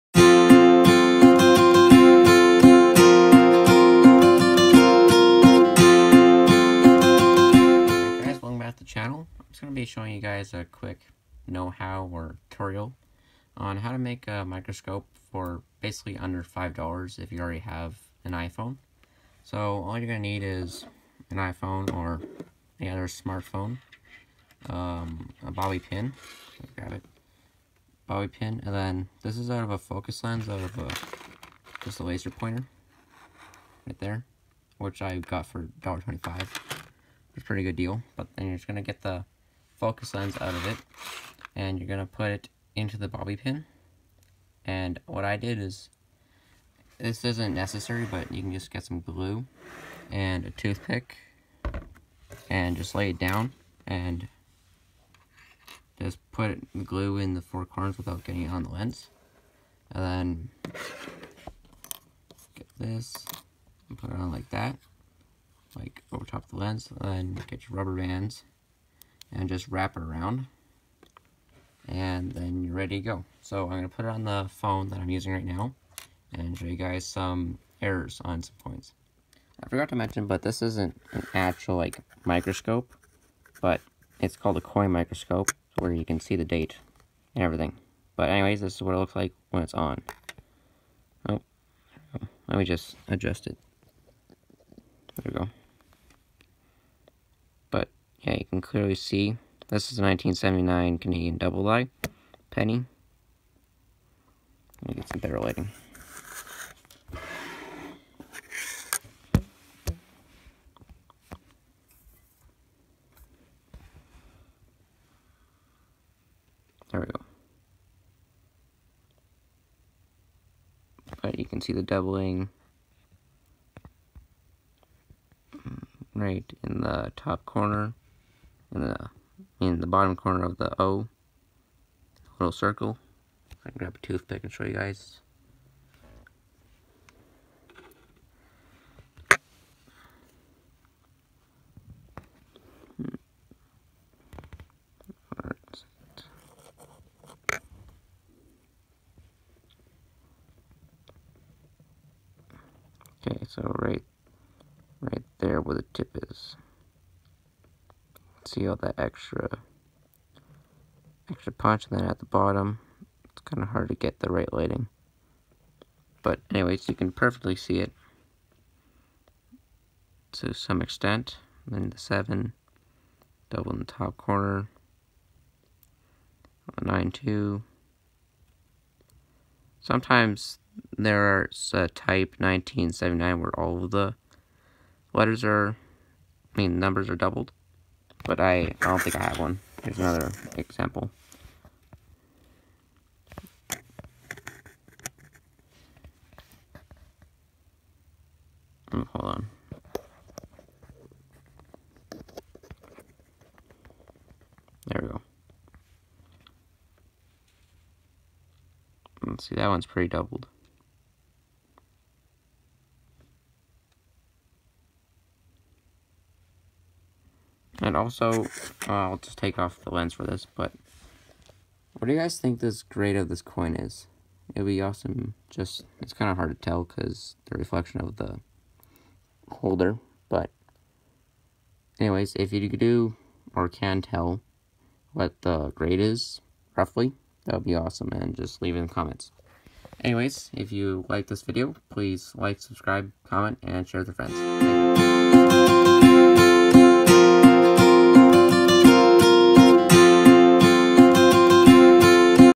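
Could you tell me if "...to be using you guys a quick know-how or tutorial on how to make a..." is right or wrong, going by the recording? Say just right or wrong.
wrong.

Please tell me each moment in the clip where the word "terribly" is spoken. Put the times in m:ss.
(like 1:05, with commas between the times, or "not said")
not said.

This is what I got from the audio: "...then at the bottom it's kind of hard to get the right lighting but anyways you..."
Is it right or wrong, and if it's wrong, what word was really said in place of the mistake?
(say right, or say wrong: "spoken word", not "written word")
right.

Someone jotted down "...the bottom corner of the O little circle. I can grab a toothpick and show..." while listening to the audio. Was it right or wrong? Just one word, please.
right.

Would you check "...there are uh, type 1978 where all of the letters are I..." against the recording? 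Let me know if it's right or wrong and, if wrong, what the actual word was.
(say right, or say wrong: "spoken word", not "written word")
wrong: "1979", not "1978".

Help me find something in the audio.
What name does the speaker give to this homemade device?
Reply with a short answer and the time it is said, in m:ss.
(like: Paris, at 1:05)
coin microscope, at 1:24.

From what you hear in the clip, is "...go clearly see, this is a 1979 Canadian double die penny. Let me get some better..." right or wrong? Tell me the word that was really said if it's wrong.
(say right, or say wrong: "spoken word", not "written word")
right.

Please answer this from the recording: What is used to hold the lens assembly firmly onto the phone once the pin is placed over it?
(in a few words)
rubber bands.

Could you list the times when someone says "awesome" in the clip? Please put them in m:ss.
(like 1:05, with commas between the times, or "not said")
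3:44, 3:57.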